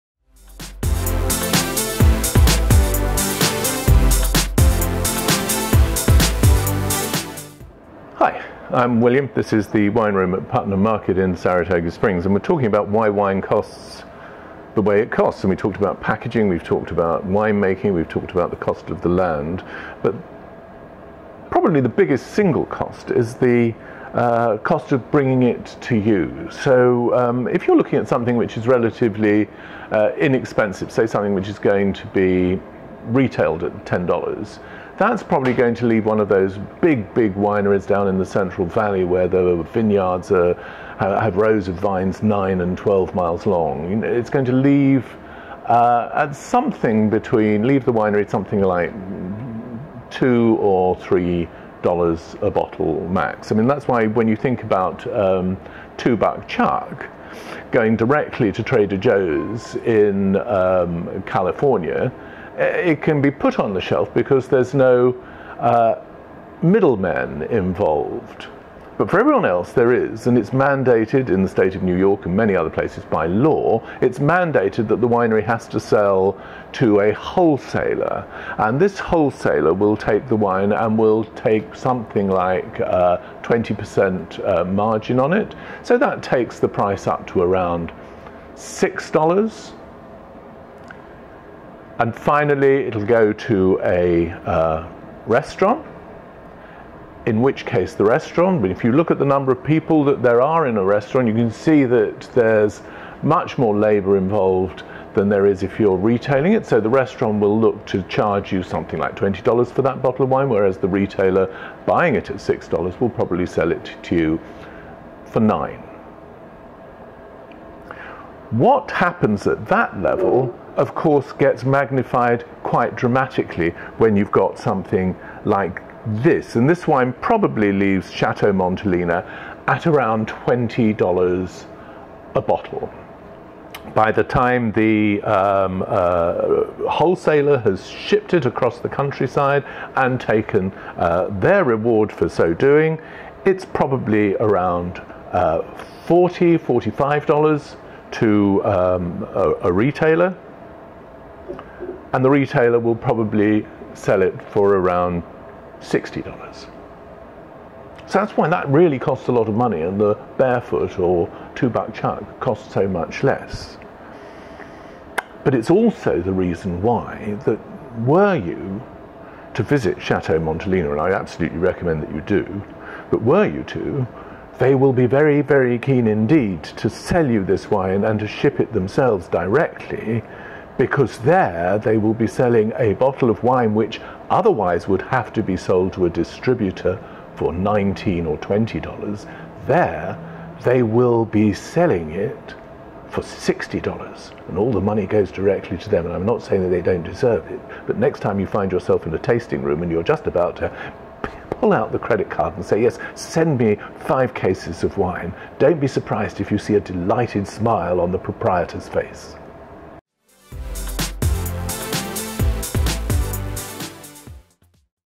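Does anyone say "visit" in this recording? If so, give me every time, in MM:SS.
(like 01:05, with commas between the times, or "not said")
02:49.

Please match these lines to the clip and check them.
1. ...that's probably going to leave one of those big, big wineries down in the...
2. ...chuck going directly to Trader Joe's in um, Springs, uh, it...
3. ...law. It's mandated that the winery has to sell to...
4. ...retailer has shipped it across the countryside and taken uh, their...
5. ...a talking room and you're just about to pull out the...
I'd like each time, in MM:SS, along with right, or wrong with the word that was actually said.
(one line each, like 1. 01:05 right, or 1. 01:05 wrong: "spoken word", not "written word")
1. 00:34 right
2. 00:56 wrong: "California", not "Springs"
3. 01:13 right
4. 02:16 wrong: "wholesaler", not "retailer"
5. 03:19 wrong: "tasting", not "talking".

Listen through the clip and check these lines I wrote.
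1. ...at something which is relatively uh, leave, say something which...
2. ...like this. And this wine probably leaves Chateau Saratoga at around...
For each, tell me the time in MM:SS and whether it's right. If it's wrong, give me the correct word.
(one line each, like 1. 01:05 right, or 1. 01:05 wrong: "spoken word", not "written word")
1. 00:27 wrong: "inexpensive", not "leave"
2. 02:05 wrong: "Montelena", not "Saratoga".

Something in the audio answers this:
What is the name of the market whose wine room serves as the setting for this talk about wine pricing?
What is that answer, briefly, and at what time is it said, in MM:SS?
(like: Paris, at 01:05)
Putnam Market, at 00:10.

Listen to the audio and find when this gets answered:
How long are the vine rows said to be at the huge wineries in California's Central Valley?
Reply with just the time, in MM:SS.
00:42.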